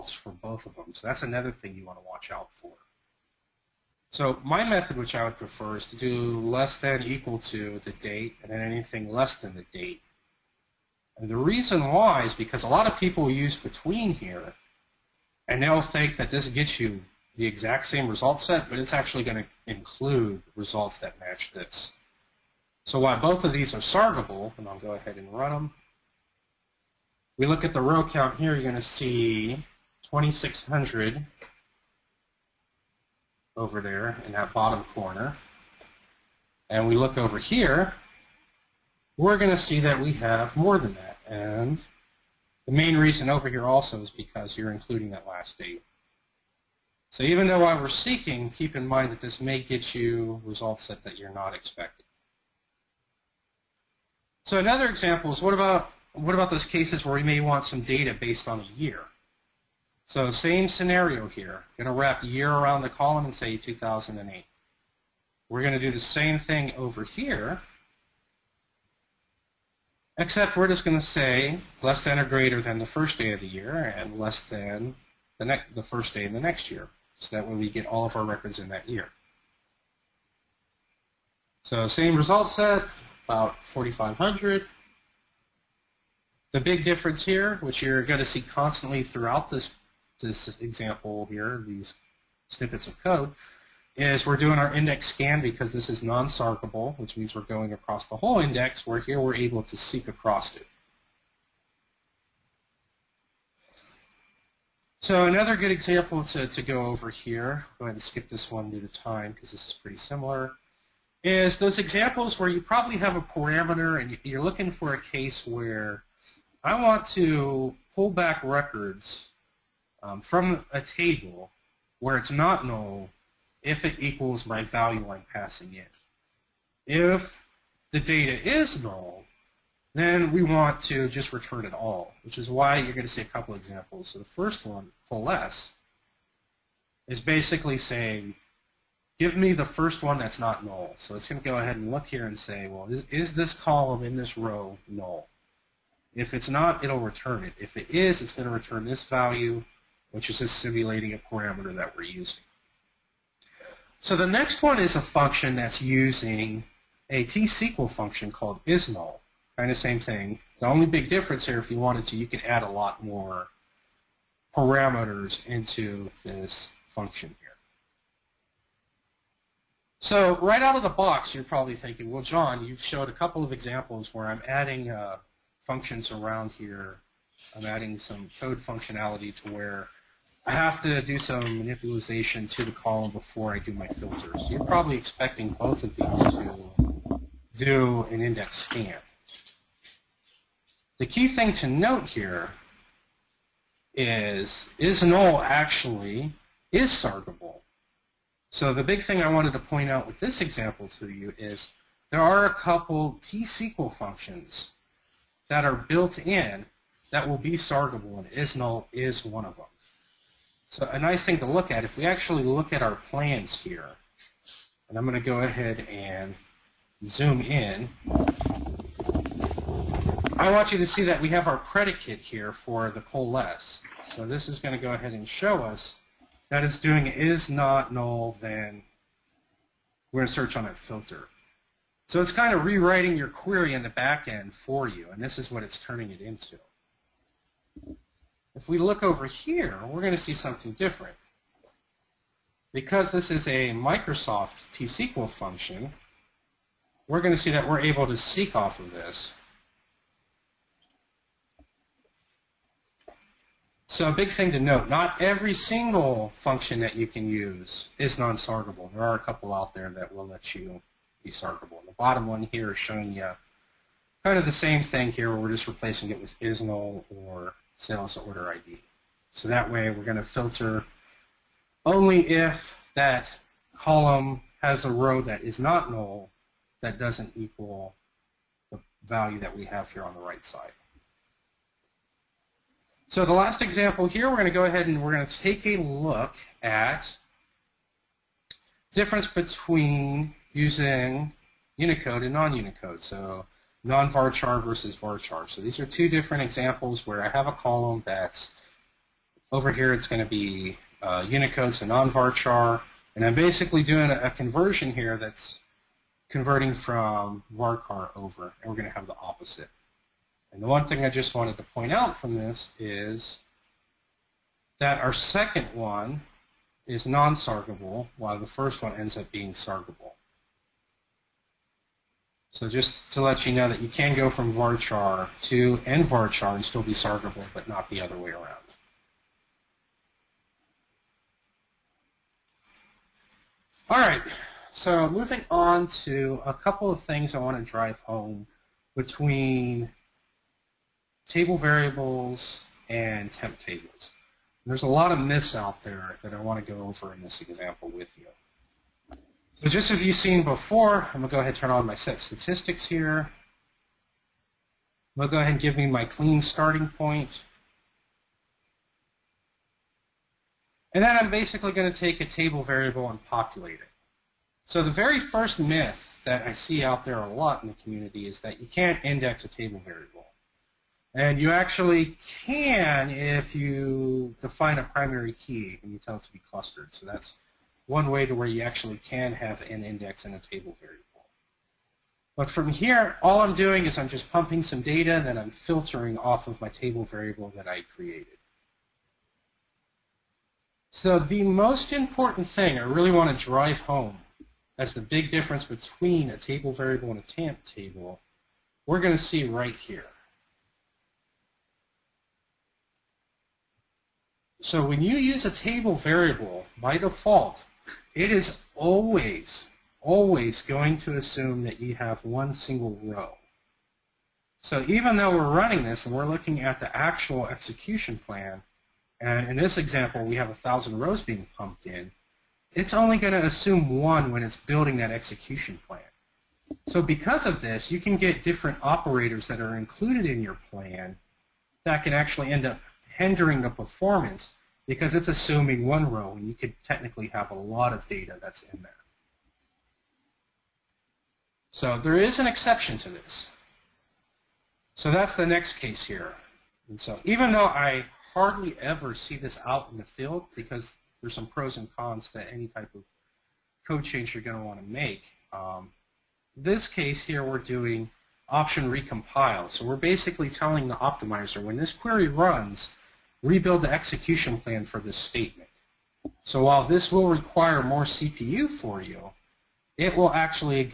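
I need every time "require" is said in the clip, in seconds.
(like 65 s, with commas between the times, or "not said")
467 s.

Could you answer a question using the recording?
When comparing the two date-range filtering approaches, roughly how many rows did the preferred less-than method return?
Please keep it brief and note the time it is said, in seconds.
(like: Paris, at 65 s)
2,600, at 30 s.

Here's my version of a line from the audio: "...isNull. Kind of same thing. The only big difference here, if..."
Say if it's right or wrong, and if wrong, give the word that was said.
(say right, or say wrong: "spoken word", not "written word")
right.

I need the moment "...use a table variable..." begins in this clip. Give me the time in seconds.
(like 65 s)
405 s.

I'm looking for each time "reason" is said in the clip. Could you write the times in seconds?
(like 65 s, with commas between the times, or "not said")
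11 s, 42 s.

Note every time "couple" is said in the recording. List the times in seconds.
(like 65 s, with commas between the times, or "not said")
133 s, 173 s, 202 s, 259 s, 336 s.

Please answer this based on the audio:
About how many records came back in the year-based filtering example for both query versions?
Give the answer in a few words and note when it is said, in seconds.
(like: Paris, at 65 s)
About 4,500, at 83 s.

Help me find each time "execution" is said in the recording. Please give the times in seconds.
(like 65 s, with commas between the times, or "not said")
417 s, 425 s, 463 s.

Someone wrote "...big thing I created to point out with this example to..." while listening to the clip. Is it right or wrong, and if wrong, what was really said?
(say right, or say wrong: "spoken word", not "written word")
wrong: "wanted", not "created".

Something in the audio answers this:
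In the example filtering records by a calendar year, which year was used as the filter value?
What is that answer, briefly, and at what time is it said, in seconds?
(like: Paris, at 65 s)
2008, at 63 s.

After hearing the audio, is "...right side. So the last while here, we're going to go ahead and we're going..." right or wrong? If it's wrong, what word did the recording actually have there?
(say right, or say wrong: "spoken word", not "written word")
wrong: "example", not "while".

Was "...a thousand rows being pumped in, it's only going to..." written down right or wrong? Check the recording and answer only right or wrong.
right.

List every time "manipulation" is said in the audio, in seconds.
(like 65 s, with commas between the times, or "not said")
181 s.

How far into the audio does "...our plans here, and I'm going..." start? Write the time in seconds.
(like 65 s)
212 s.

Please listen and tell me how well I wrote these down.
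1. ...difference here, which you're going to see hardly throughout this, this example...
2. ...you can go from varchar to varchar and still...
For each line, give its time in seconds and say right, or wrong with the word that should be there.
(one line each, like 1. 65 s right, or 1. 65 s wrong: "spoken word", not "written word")
1. 86 s wrong: "constantly", not "hardly"
2. 323 s wrong: "nvarchar", not "varchar".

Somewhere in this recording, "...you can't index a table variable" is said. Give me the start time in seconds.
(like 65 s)
368 s.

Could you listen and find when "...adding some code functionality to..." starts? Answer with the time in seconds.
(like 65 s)
177 s.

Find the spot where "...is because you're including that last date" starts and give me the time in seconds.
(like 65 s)
44 s.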